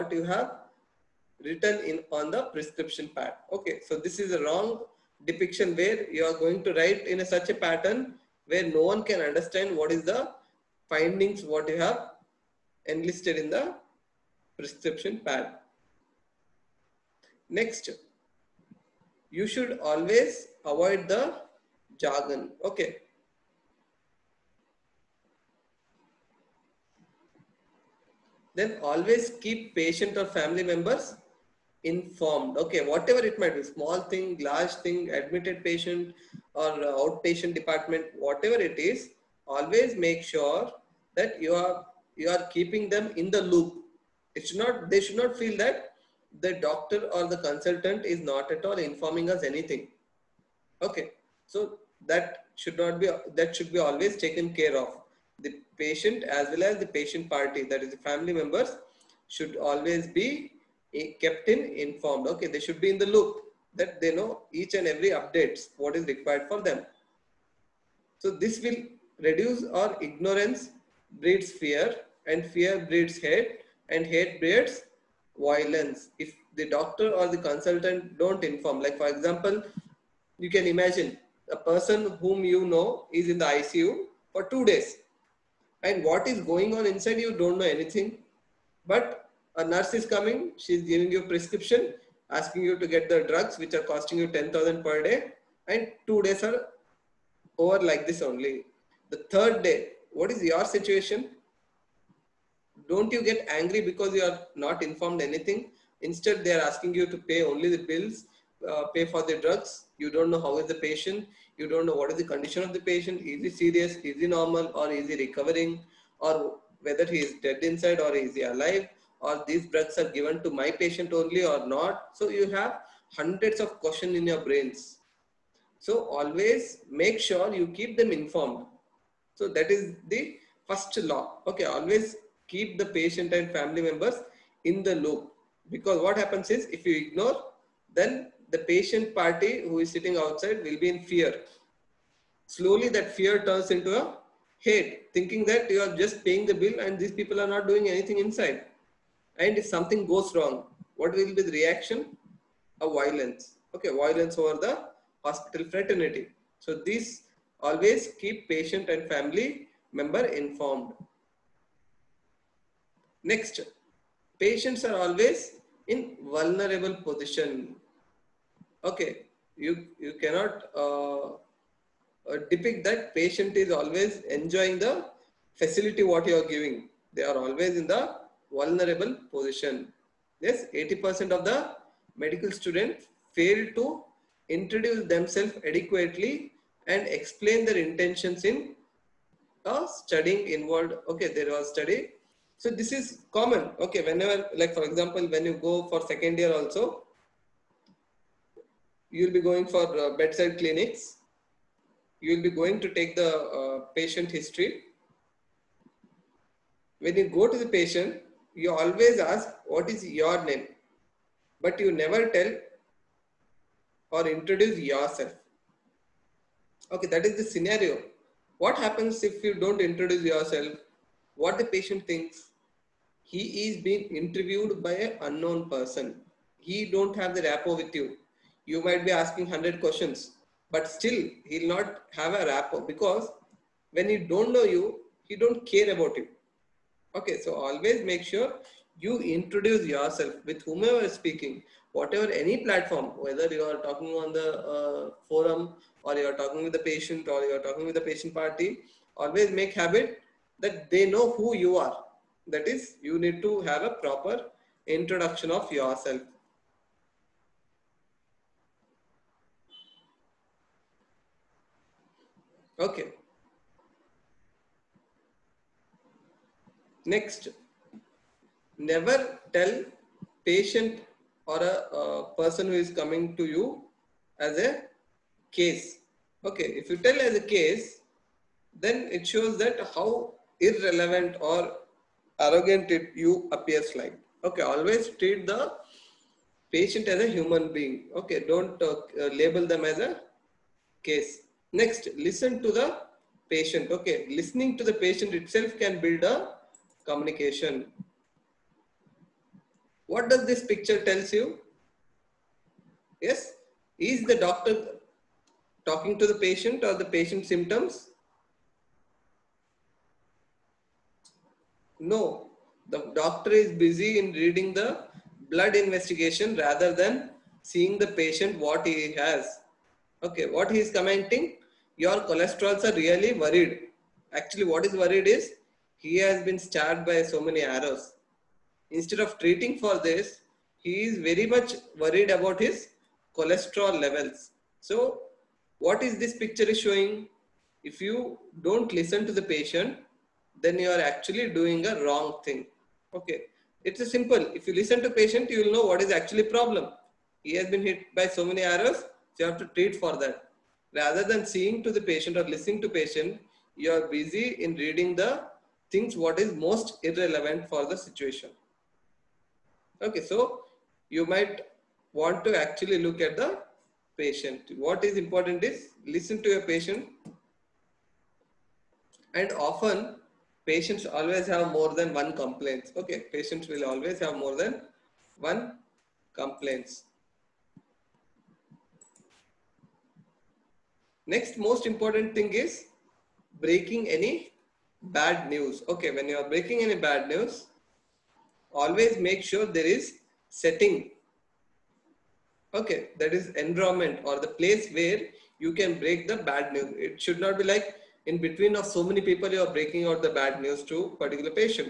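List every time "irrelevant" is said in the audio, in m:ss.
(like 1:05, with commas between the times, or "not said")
4:40, 5:57.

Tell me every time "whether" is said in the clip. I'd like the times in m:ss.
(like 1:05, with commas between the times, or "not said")
1:56, 4:03.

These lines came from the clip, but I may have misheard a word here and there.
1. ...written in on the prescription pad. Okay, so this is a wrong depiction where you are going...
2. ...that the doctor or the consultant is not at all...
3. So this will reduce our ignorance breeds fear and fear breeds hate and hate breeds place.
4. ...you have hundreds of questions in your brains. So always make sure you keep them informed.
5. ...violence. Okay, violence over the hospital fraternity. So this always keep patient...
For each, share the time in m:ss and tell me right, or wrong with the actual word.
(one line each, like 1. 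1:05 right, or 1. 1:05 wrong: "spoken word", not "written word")
1. 0:01 right
2. 0:45 right
3. 1:08 wrong: "violence", not "place"
4. 2:02 right
5. 2:32 right.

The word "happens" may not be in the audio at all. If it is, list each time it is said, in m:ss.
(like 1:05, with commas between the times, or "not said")
2:16, 3:38.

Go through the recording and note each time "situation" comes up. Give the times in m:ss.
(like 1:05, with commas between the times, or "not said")
1:40, 5:57.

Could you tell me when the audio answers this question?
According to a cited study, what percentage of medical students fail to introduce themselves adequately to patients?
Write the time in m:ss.
3:00.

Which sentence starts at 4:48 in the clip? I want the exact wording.
Okay, don't uh, label them as a case.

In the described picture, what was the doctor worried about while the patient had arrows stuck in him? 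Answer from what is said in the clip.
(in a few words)
Cholesterol.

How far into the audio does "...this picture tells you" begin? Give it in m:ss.
5:00.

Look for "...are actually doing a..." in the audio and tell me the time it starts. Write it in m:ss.
5:40.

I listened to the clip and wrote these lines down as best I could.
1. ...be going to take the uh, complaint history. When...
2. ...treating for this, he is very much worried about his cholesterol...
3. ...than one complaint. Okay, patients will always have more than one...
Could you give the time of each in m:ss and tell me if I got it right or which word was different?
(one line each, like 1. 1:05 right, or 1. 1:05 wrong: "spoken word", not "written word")
1. 3:22 wrong: "patient", not "complaint"
2. 5:29 right
3. 6:11 right.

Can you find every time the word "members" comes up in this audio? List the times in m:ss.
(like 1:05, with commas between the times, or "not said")
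0:30, 0:58, 2:13, 2:39.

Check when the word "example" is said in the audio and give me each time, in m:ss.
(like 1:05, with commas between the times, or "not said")
1:19, 3:14.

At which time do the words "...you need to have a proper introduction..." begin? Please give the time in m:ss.
4:13.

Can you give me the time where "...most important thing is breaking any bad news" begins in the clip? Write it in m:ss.
6:21.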